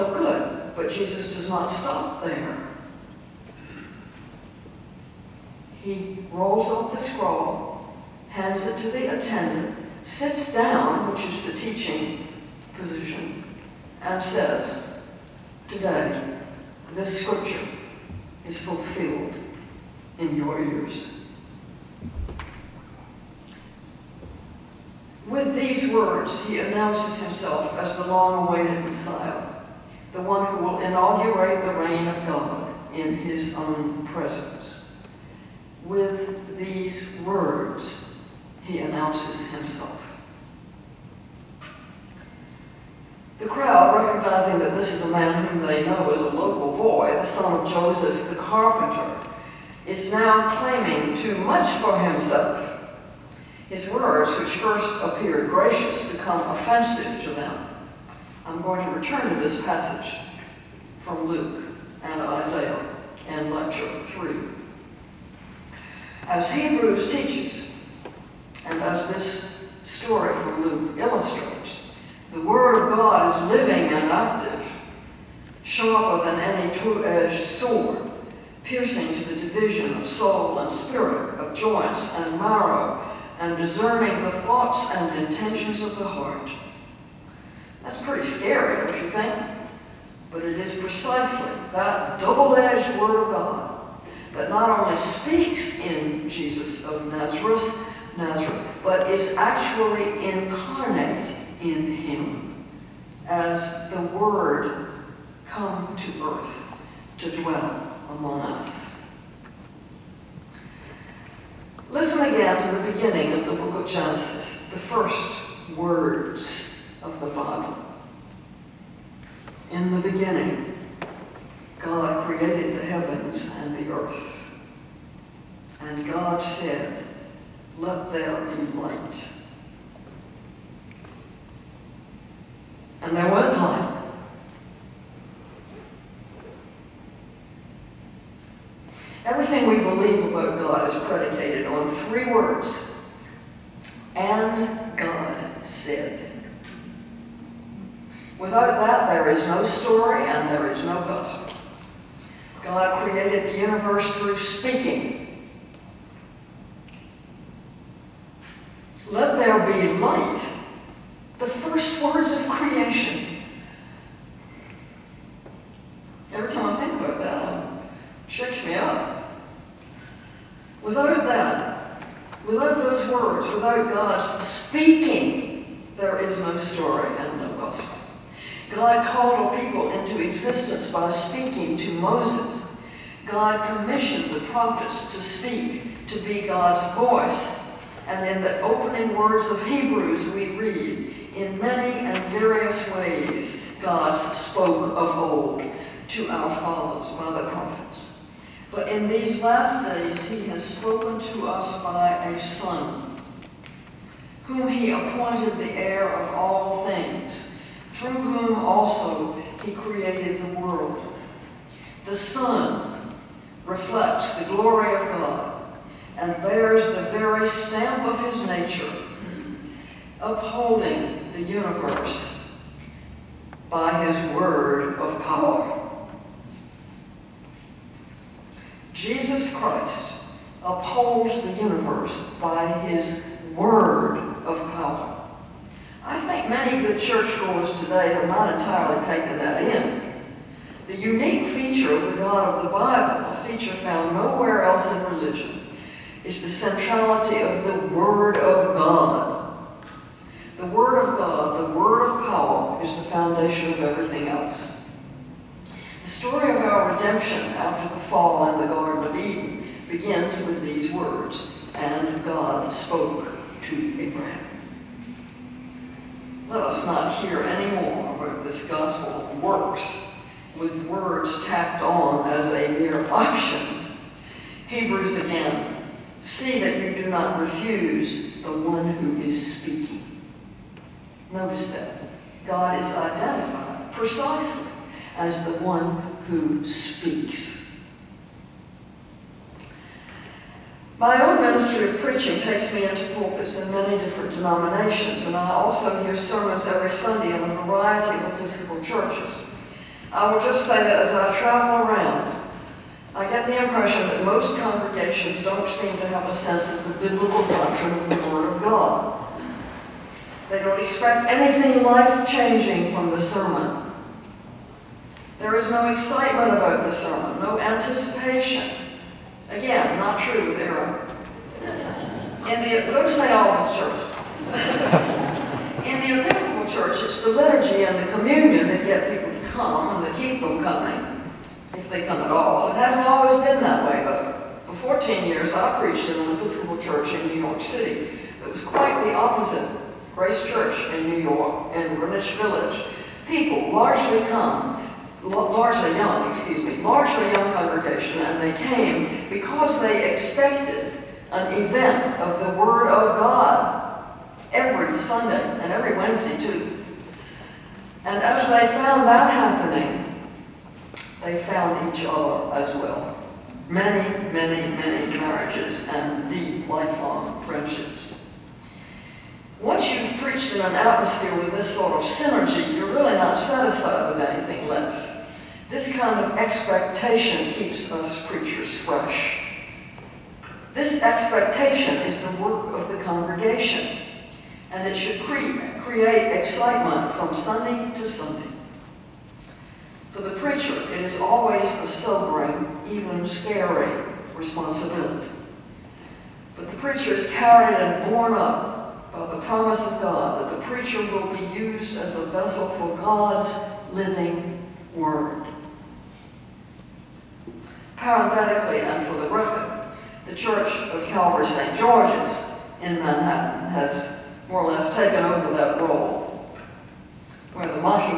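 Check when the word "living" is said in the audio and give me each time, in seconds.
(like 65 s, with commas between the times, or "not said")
73 s, 403 s.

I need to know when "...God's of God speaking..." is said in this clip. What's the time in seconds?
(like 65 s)
173 s.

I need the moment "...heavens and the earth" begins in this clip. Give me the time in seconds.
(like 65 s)
122 s.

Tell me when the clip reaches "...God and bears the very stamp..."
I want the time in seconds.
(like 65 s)
215 s.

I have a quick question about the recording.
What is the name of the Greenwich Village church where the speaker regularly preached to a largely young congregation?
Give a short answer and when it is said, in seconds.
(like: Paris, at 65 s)
Grace Church, at 340 s.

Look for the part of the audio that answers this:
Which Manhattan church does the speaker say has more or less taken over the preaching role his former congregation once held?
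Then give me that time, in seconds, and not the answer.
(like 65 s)
411 s.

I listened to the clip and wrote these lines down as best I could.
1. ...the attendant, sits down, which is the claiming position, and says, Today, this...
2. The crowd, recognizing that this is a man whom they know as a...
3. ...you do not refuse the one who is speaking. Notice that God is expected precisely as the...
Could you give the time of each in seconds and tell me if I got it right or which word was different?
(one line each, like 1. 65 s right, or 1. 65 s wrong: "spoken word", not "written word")
1. 8 s wrong: "teaching", not "claiming"
2. 43 s right
3. 276 s wrong: "identified", not "expected".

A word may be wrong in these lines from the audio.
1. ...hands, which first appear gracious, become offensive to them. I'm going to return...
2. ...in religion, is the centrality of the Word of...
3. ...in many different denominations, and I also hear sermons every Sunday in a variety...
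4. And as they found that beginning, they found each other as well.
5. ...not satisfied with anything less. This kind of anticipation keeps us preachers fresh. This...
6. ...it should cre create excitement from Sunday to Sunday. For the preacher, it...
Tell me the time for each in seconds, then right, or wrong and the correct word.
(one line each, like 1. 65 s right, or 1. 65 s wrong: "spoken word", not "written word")
1. 53 s wrong: "words", not "hands"
2. 244 s right
3. 293 s right
4. 358 s wrong: "happening", not "beginning"
5. 373 s wrong: "expectation", not "anticipation"
6. 384 s right.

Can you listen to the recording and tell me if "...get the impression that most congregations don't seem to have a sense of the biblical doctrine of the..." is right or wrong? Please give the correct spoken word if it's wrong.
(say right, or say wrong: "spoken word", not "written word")
right.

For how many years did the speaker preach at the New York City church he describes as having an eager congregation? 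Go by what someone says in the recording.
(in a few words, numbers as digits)
14.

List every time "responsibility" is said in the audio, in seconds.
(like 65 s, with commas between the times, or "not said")
394 s.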